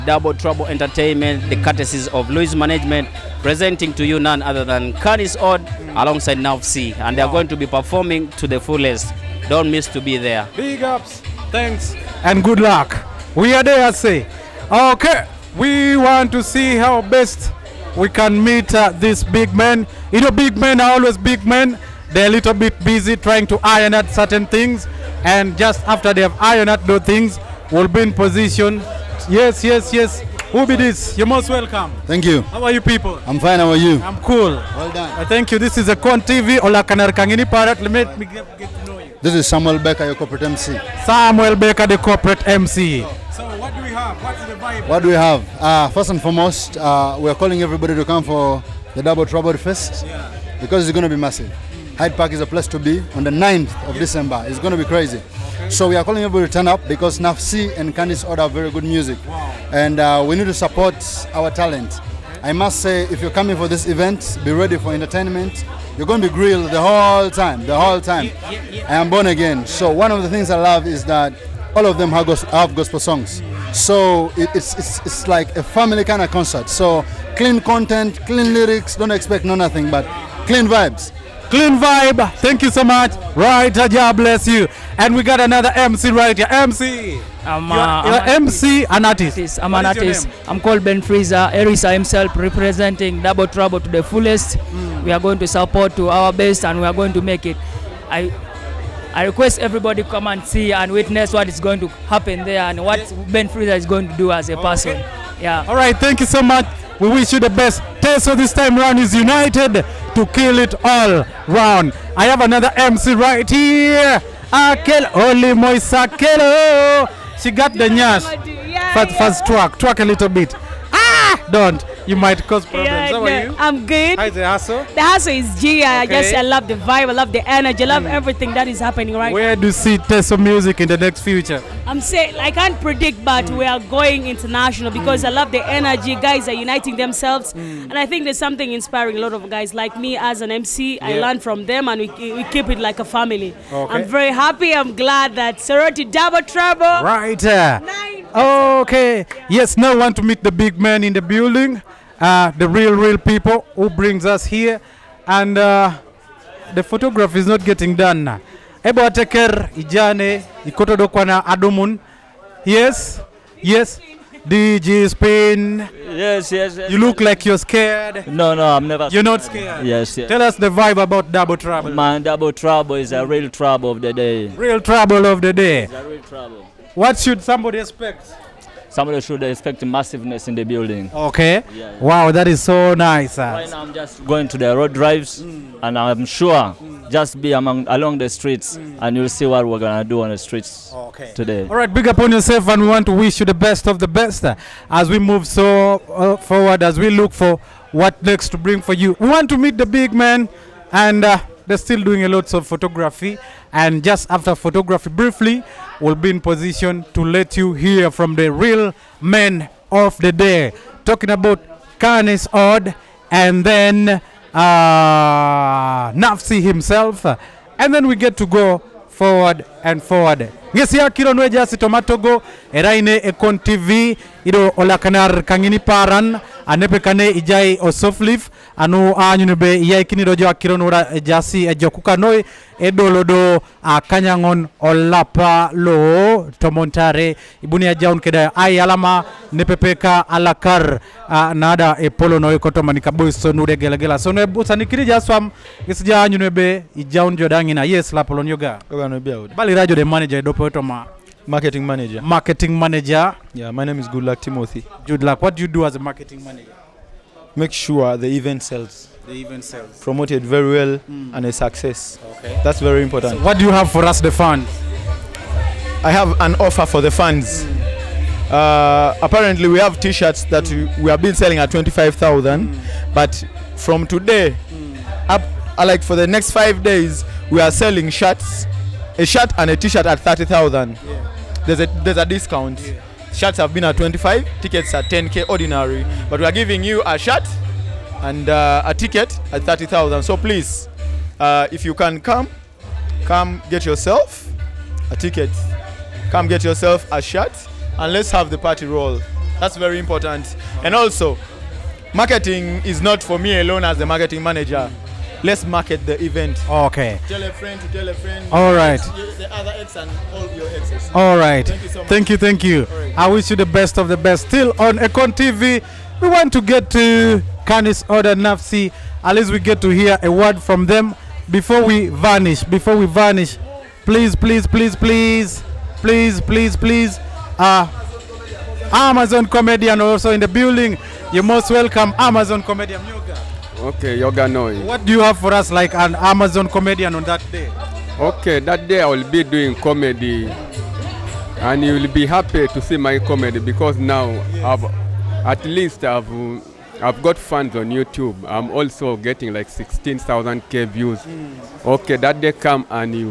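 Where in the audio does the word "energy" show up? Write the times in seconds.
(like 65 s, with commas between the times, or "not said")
127 s, 135 s.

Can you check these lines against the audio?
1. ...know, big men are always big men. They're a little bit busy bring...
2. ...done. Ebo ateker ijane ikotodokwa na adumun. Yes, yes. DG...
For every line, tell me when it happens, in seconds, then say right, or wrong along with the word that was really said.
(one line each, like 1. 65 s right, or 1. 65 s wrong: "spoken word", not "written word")
1. 20 s wrong: "trying", not "bring"
2. 157 s right.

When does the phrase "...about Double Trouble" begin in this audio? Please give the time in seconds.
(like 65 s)
171 s.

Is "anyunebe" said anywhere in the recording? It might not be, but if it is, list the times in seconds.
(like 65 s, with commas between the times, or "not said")
229 s, 246 s.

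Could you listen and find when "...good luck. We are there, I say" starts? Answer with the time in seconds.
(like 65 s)
12 s.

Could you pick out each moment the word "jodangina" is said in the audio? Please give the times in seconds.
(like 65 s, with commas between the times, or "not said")
247 s.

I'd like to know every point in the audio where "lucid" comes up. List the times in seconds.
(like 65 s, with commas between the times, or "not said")
not said.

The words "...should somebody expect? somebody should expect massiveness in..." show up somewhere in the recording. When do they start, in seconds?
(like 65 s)
177 s.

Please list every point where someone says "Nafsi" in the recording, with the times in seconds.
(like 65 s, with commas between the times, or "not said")
6 s, 57 s, 216 s, 318 s.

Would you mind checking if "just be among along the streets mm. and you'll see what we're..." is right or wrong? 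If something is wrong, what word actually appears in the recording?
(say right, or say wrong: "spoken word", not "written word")
right.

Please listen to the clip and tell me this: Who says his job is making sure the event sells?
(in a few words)
Goodluck Timothy.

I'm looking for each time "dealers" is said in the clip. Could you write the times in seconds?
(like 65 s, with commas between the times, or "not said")
not said.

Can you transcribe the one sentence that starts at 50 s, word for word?
because it's going to be massive.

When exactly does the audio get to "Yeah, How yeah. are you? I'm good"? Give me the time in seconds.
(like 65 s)
122 s.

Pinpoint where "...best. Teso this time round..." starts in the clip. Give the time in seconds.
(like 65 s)
107 s.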